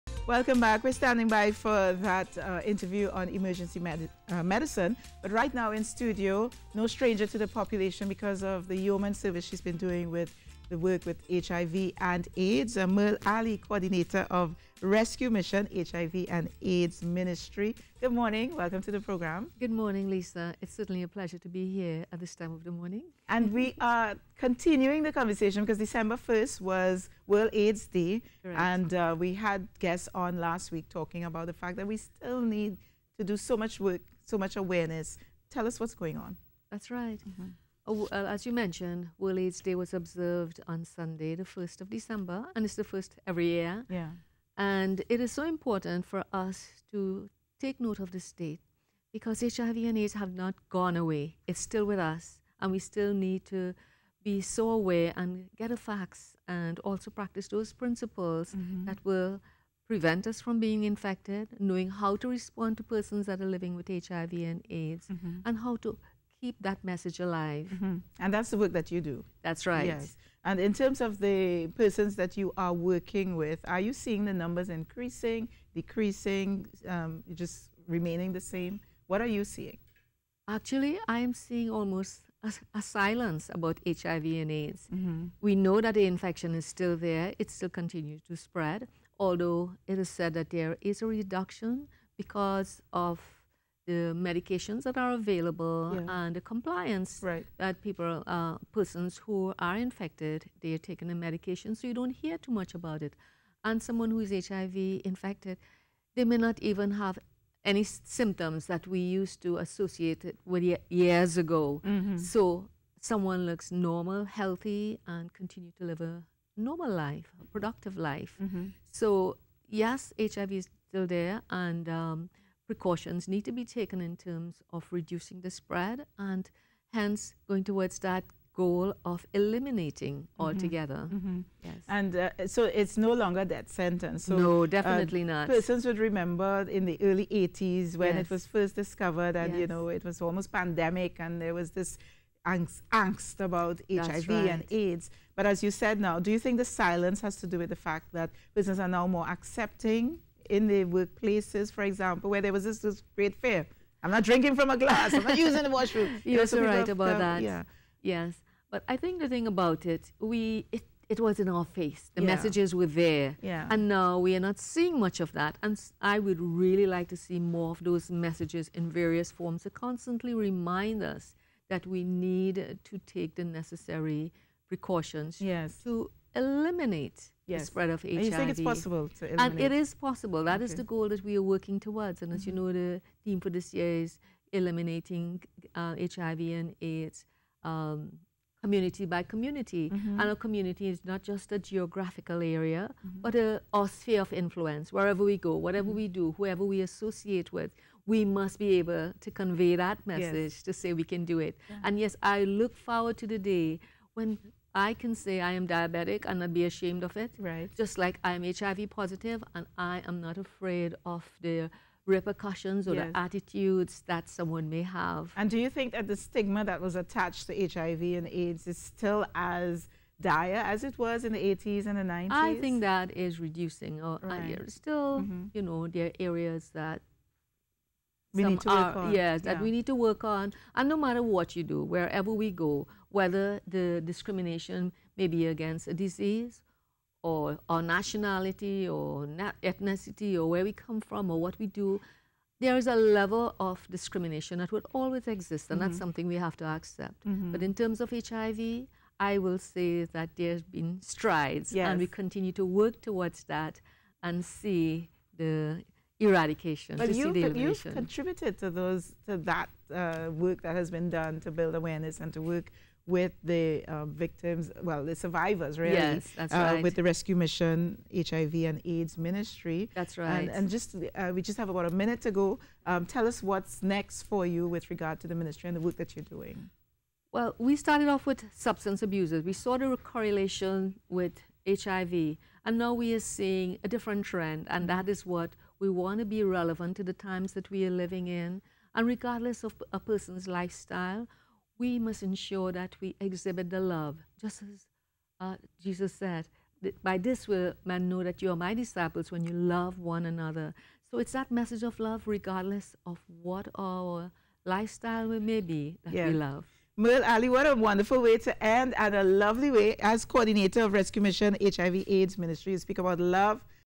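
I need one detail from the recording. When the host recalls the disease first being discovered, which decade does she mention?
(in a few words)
early 80s.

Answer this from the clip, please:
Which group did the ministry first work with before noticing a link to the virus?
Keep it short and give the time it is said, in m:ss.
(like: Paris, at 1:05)
substance abusers, at 4:38.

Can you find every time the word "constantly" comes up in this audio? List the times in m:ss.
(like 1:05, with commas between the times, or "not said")
2:49.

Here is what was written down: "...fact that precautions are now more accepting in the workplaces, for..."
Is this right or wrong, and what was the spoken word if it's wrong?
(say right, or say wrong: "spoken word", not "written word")
wrong: "persons", not "precautions".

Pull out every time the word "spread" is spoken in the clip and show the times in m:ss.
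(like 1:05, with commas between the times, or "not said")
1:28, 2:05, 2:57.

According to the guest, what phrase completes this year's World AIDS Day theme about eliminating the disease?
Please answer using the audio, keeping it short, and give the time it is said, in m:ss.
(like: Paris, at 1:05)
community by community, at 3:08.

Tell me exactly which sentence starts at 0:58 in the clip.
that will prevent us from being infected, knowing how to respond to persons that are living with HIV and AIDS, mm-hmm.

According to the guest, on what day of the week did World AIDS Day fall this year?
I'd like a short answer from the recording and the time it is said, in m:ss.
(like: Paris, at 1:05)
Sunday, at 0:40.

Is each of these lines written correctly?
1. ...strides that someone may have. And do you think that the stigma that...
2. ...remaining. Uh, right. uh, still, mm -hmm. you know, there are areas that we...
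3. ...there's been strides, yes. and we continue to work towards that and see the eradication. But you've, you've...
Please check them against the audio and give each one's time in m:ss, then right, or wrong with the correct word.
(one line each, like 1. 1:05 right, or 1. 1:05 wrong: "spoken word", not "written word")
1. 3:33 wrong: "attitudes", not "strides"
2. 3:43 wrong: "reducing", not "remaining"
3. 4:10 right.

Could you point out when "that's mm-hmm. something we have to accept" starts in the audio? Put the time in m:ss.
4:05.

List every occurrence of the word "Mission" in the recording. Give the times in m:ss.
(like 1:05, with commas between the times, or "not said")
0:15, 4:27, 5:11.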